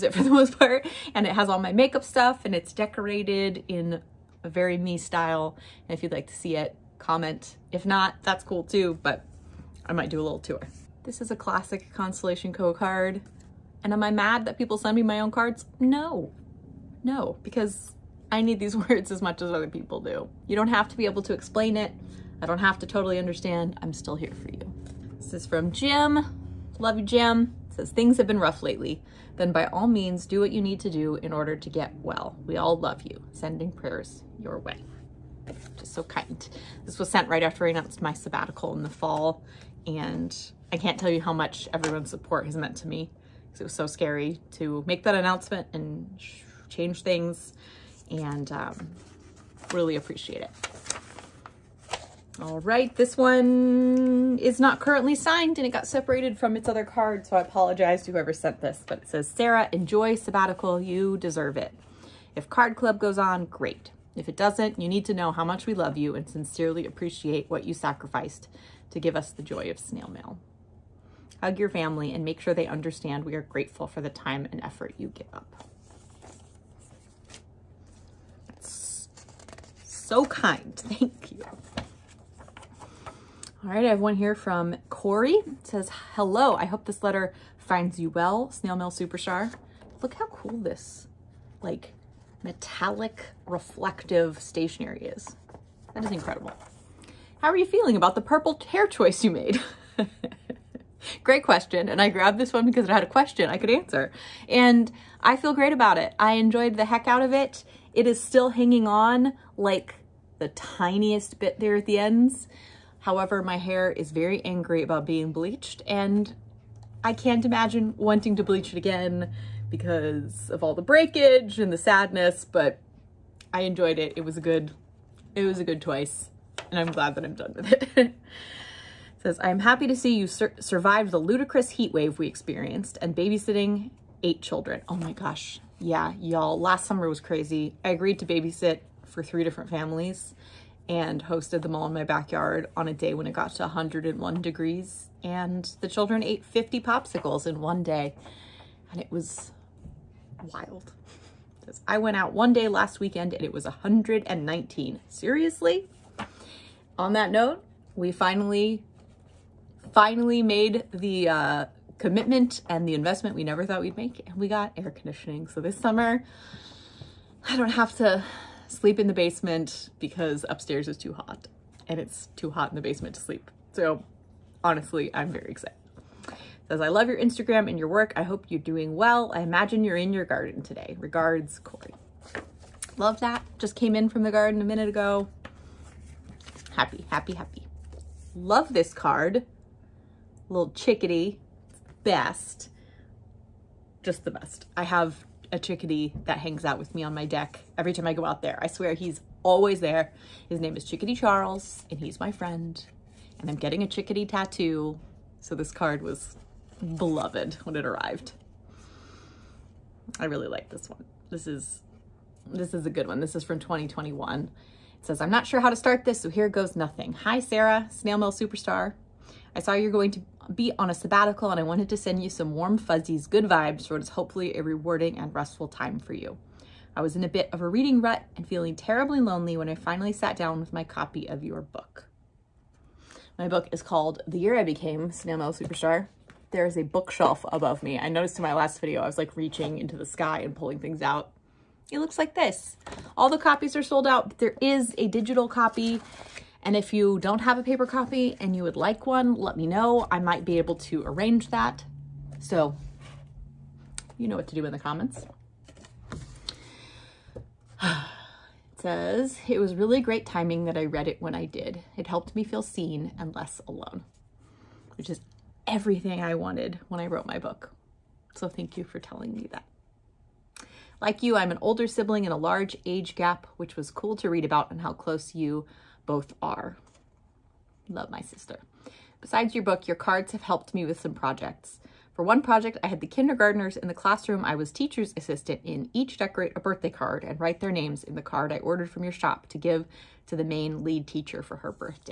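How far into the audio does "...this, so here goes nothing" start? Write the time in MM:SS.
03:36.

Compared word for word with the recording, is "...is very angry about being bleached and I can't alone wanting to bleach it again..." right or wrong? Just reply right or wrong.
wrong.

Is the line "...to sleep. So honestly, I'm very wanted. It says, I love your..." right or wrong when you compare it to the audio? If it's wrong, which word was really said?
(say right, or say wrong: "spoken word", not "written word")
wrong: "excited", not "wanted".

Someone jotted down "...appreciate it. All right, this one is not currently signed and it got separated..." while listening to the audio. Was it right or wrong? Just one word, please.
right.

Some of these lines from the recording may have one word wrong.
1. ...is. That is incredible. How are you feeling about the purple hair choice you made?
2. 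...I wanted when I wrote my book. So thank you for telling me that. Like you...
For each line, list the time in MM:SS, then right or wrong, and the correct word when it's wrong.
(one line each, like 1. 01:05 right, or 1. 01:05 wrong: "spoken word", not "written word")
1. 01:35 right
2. 04:26 right.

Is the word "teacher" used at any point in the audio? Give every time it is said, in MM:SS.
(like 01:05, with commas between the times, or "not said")
04:44, 04:51.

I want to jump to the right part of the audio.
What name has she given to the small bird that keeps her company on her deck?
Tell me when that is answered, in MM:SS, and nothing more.
03:20.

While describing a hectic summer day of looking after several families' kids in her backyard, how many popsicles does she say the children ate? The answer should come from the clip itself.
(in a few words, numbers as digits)
50.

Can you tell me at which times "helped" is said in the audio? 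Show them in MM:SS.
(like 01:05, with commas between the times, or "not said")
04:22, 04:40.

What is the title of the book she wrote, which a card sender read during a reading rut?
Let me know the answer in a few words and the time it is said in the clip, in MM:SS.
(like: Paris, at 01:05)
The Year I Became Snail Superstar, at 03:54.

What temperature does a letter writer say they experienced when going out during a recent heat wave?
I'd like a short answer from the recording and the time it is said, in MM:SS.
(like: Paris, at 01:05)
119, at 02:33.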